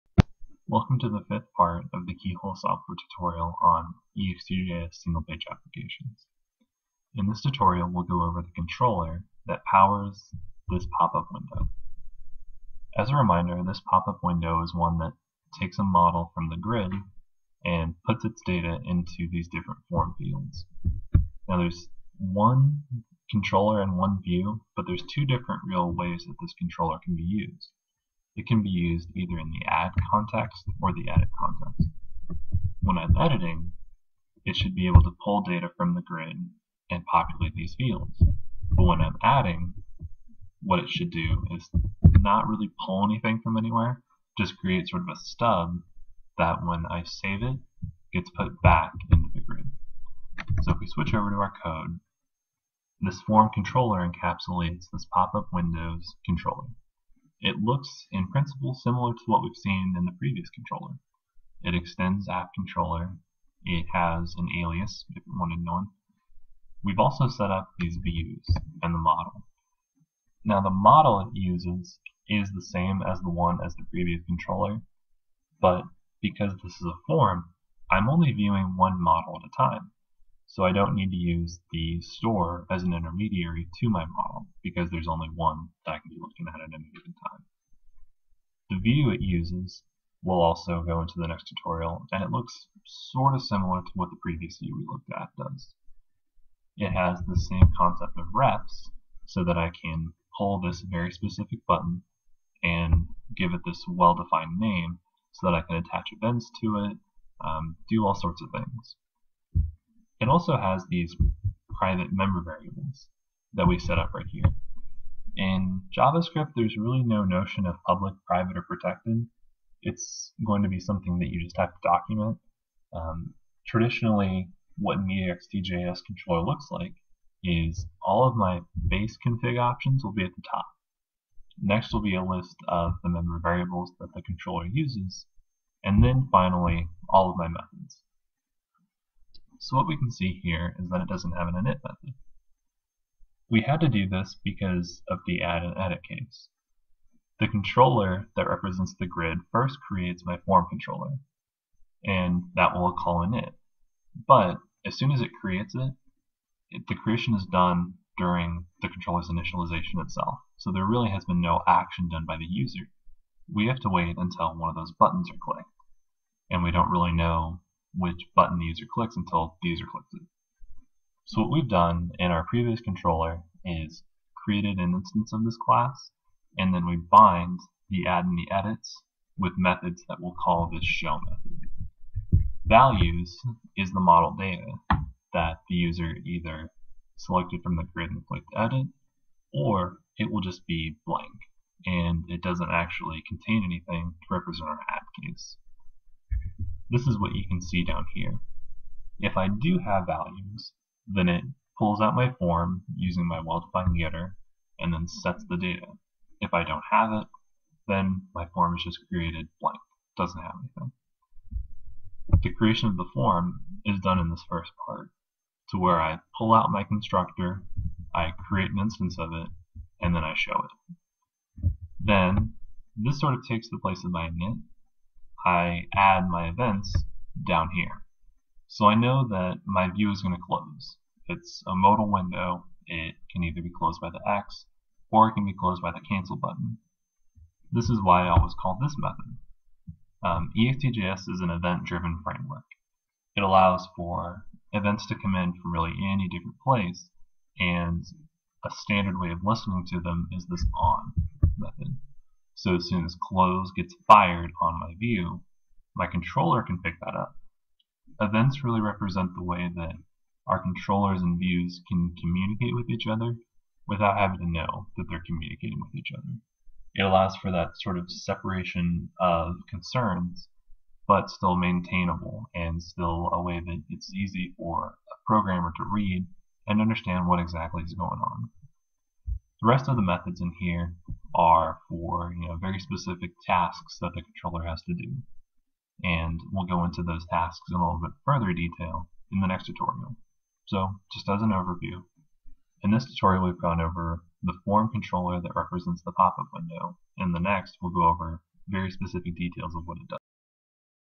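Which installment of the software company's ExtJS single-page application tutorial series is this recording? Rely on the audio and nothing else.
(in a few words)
Fifth.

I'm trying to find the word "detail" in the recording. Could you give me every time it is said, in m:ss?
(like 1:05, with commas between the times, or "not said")
4:48, 4:59.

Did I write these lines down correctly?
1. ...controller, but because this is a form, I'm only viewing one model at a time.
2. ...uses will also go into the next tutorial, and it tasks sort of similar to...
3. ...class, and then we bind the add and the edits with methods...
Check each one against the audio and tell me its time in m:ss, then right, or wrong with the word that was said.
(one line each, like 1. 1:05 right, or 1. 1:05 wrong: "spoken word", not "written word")
1. 1:14 right
2. 1:29 wrong: "looks", not "tasks"
3. 2:55 right.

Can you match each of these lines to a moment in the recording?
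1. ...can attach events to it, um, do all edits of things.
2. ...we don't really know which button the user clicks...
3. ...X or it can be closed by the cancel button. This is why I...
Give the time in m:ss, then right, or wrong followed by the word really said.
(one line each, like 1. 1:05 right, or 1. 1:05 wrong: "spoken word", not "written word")
1. 1:45 wrong: "sorts", not "edits"
2. 2:46 right
3. 3:54 right.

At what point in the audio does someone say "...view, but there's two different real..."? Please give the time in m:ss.
0:24.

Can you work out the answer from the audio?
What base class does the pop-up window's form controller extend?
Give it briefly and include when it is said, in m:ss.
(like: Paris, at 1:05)
App controller, at 1:02.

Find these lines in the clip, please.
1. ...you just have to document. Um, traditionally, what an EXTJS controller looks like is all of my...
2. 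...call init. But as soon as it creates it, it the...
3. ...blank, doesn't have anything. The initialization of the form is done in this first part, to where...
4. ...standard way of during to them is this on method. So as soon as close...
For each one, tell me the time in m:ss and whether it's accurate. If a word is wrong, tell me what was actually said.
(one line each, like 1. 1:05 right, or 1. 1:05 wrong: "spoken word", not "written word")
1. 2:01 right
2. 2:32 right
3. 3:29 wrong: "creation", not "initialization"
4. 4:08 wrong: "listening", not "during".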